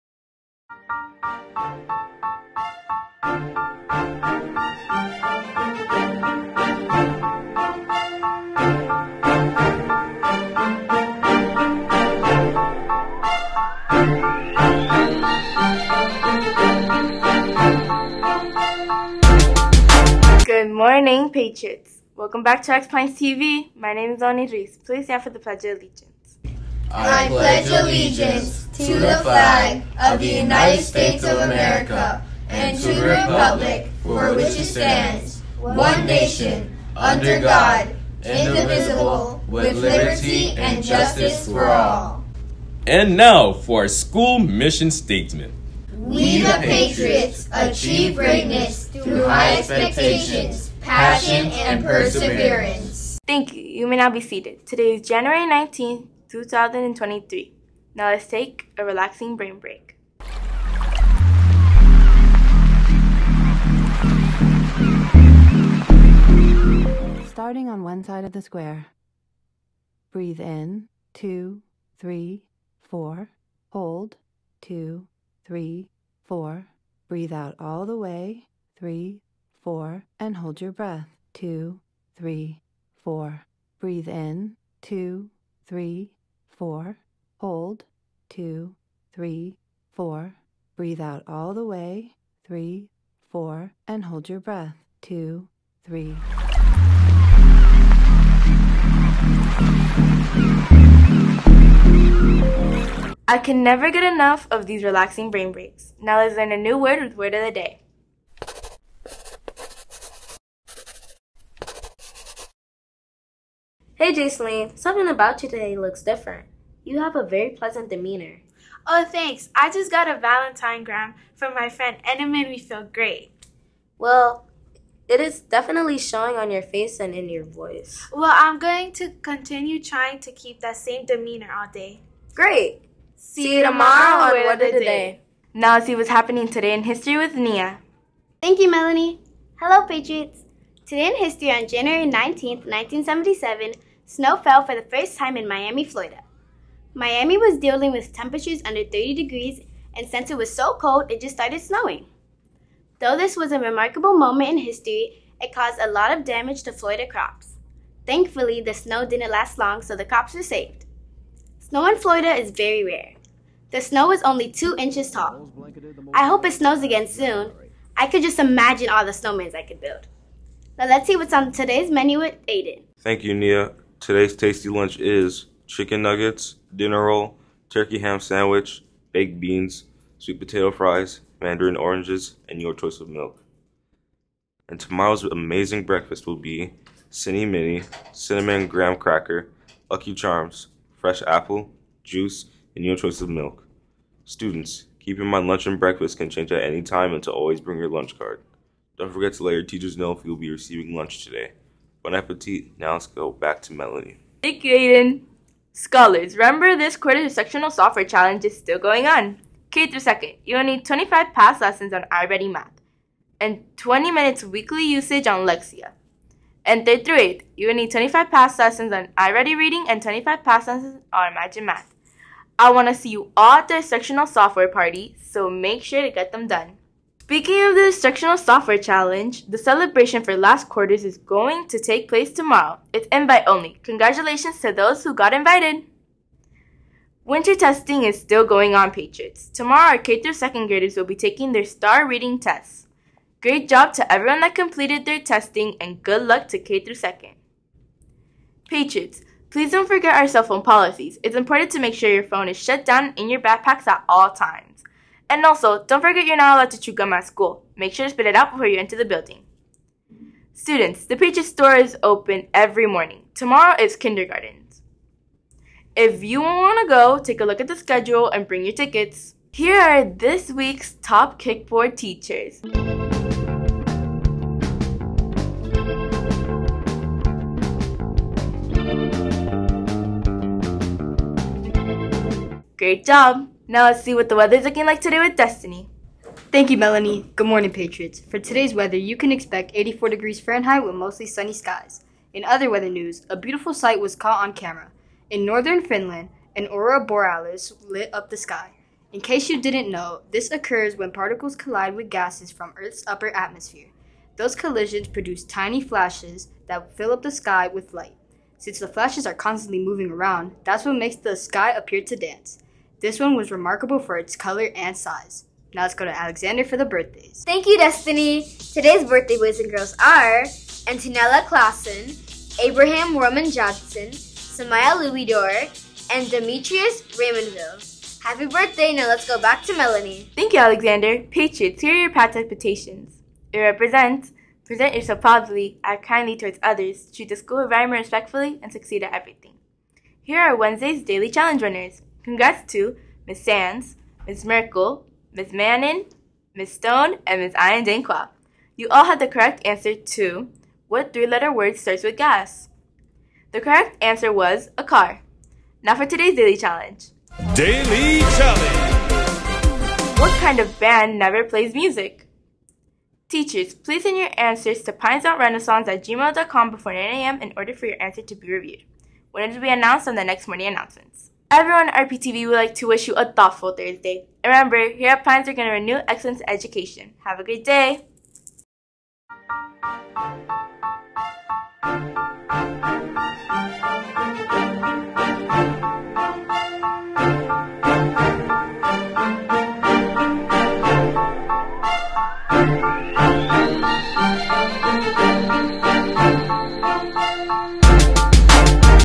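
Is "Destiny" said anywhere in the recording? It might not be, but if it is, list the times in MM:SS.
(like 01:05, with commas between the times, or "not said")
04:45, 05:17.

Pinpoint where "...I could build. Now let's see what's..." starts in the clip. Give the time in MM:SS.
02:49.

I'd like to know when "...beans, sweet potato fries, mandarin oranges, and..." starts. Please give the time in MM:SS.
02:59.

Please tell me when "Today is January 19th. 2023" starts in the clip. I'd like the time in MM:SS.
00:54.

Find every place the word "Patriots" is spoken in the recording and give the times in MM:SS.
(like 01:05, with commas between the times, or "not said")
00:21, 00:46, 02:19, 03:58, 04:08, 04:47, 05:31.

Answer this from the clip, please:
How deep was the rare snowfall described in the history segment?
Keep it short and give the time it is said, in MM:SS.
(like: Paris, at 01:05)
2 inches, at 02:44.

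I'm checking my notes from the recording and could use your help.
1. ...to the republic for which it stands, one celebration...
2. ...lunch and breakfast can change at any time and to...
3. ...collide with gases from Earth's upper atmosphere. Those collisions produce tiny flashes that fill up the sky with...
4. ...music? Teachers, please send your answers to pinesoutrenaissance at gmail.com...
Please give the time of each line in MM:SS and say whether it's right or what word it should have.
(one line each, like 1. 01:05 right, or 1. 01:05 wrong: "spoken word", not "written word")
1. 00:32 wrong: "nation", not "celebration"
2. 03:15 right
3. 05:01 right
4. 06:01 right.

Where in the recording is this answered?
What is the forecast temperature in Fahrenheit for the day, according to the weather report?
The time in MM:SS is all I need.
04:49.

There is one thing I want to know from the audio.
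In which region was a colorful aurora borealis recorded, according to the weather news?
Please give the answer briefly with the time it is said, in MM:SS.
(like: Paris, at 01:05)
Northern Finland, at 04:55.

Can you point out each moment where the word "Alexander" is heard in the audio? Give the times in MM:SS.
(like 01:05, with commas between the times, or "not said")
05:16, 05:30.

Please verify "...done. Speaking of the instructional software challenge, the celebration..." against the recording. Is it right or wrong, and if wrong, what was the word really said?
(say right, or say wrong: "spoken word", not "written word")
right.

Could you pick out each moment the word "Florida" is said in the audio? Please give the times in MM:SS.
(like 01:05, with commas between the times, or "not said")
02:25, 02:36, 02:41.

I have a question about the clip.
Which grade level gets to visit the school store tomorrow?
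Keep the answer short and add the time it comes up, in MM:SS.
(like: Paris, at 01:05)
Kindergarten, at 04:23.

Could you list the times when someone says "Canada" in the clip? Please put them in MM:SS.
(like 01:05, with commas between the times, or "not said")
not said.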